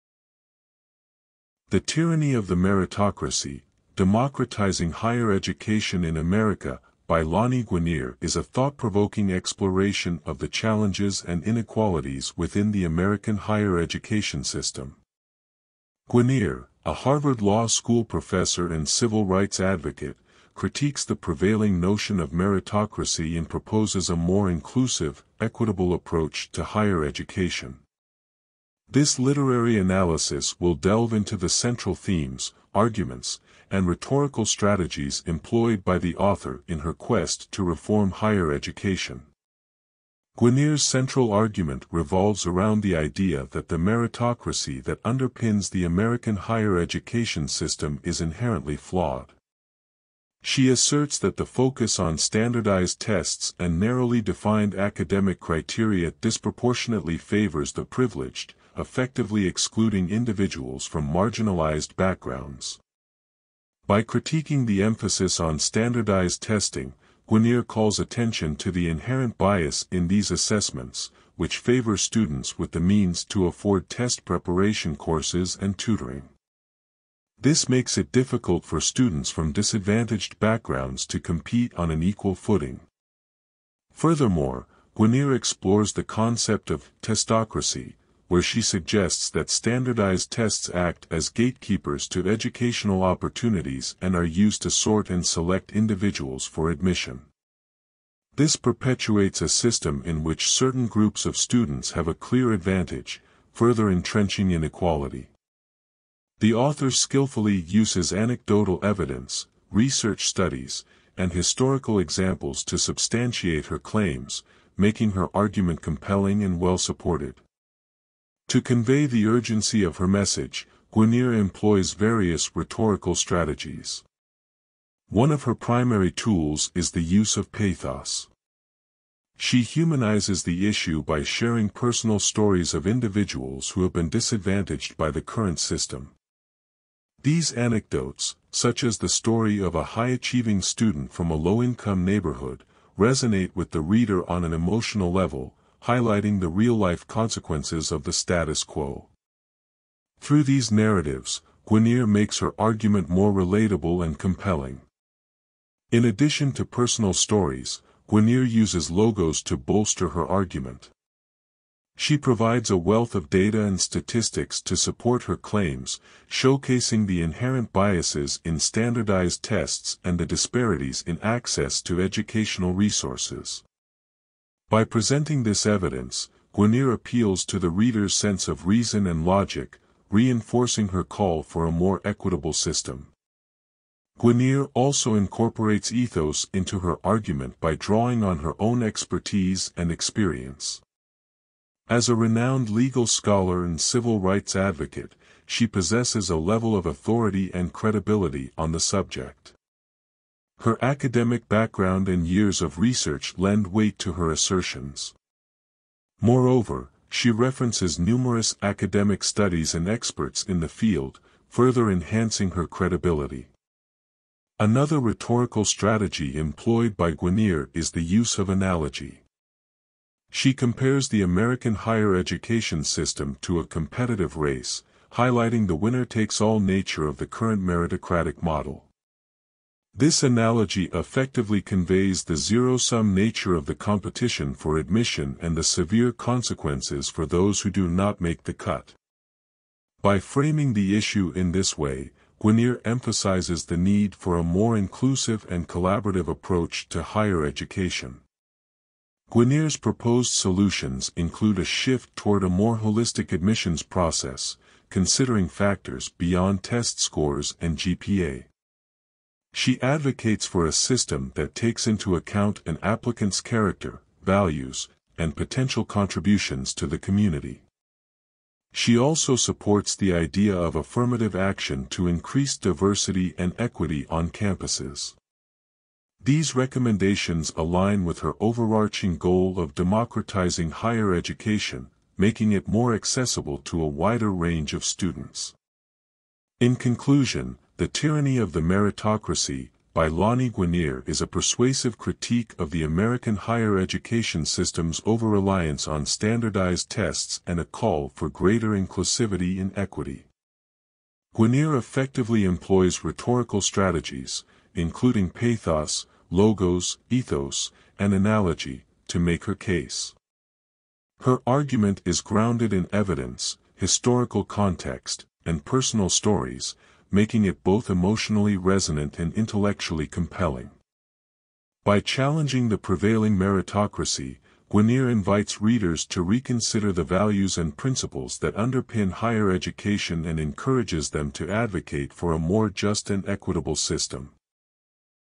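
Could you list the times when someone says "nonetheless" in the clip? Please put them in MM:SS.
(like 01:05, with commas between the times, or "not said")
not said.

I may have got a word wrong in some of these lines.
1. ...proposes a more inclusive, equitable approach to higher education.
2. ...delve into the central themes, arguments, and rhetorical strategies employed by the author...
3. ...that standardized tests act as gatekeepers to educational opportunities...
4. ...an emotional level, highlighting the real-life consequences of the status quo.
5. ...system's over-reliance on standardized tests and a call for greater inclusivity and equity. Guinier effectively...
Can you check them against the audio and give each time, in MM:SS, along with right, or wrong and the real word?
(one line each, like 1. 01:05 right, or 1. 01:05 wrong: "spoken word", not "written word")
1. 00:23 right
2. 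00:30 right
3. 01:29 right
4. 02:24 right
5. 04:54 right.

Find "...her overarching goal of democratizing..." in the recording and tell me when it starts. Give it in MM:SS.
04:38.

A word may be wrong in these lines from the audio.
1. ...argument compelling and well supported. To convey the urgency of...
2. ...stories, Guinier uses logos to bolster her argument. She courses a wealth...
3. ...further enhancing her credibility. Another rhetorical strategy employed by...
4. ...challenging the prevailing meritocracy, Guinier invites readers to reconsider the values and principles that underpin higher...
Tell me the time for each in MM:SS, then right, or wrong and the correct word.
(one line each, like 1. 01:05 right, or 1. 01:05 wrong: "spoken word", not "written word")
1. 01:55 right
2. 02:37 wrong: "provides", not "courses"
3. 03:31 right
4. 05:21 right.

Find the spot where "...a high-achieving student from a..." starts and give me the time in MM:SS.
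02:19.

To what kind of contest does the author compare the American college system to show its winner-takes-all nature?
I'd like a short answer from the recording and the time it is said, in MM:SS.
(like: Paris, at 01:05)
a competitive race, at 03:43.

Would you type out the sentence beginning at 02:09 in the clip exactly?
She humanizes the issue by sharing personal stories of individuals who have been disadvantaged by the current system.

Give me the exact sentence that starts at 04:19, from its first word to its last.
She advocates for a system that takes into account an applicant's character, values, and potential contributions to the community.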